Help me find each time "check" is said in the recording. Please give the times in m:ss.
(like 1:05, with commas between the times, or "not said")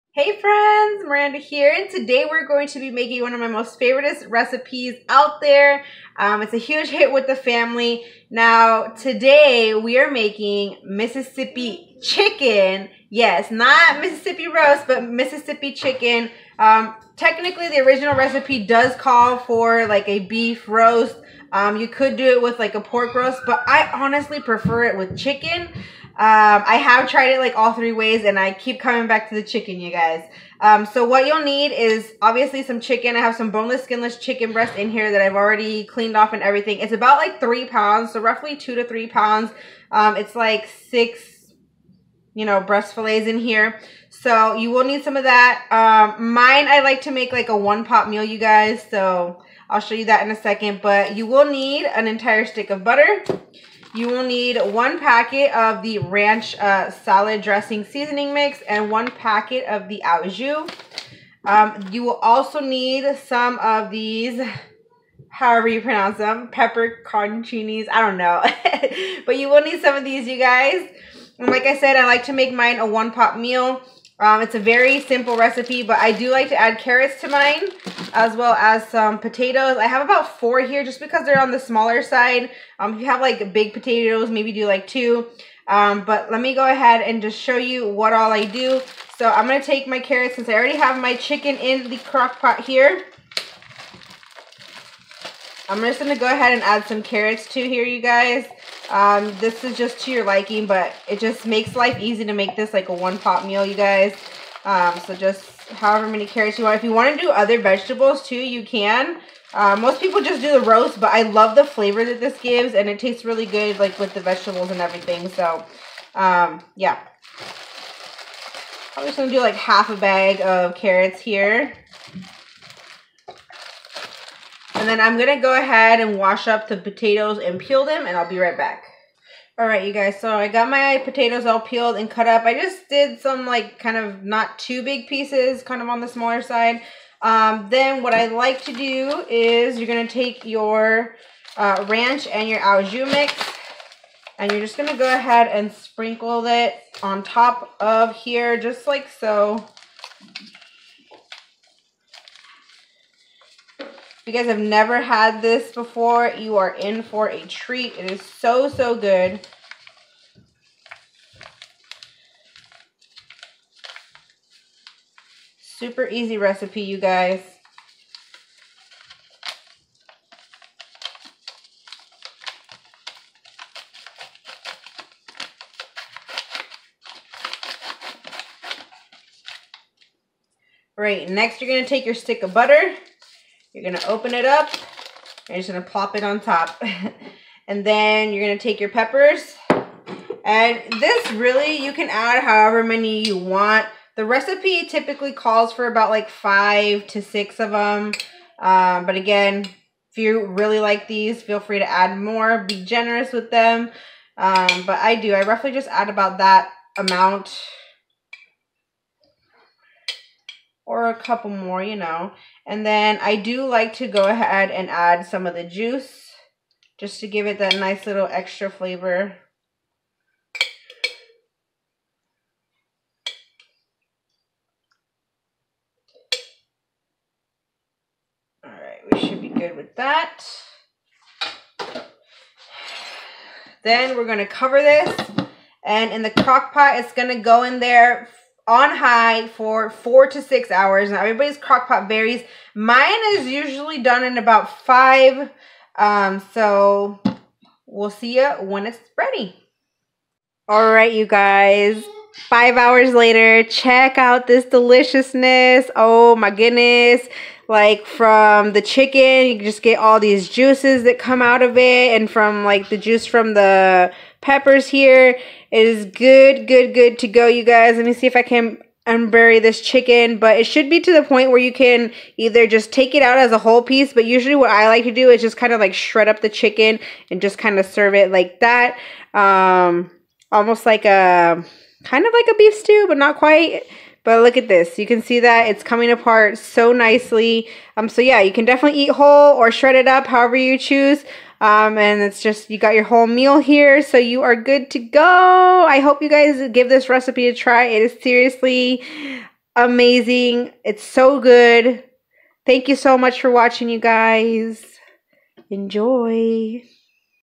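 4:13.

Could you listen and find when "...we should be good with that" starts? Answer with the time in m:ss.
3:49.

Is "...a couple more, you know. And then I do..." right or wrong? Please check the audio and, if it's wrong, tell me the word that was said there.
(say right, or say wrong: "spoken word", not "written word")
right.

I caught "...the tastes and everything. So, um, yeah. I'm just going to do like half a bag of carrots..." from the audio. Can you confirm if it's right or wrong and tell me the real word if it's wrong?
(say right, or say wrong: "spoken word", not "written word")
wrong: "vegetables", not "tastes".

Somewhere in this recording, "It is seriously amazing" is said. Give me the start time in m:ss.
4:57.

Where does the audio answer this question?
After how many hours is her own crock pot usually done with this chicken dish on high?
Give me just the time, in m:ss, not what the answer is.
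4:04.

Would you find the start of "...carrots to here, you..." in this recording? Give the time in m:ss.
1:37.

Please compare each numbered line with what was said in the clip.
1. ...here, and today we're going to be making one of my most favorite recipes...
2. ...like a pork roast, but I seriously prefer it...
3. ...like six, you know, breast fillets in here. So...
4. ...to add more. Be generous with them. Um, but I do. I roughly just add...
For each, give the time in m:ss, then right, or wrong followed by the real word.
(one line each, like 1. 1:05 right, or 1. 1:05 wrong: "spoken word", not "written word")
1. 0:01 right
2. 0:22 wrong: "honestly", not "seriously"
3. 0:40 right
4. 3:21 right.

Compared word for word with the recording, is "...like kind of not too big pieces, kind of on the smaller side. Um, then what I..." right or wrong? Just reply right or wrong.
right.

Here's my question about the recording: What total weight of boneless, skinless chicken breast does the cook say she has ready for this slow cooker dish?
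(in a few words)
3 pounds.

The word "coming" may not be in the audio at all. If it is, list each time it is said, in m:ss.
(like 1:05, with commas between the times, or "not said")
0:28, 4:45.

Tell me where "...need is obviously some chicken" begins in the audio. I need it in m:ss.
0:31.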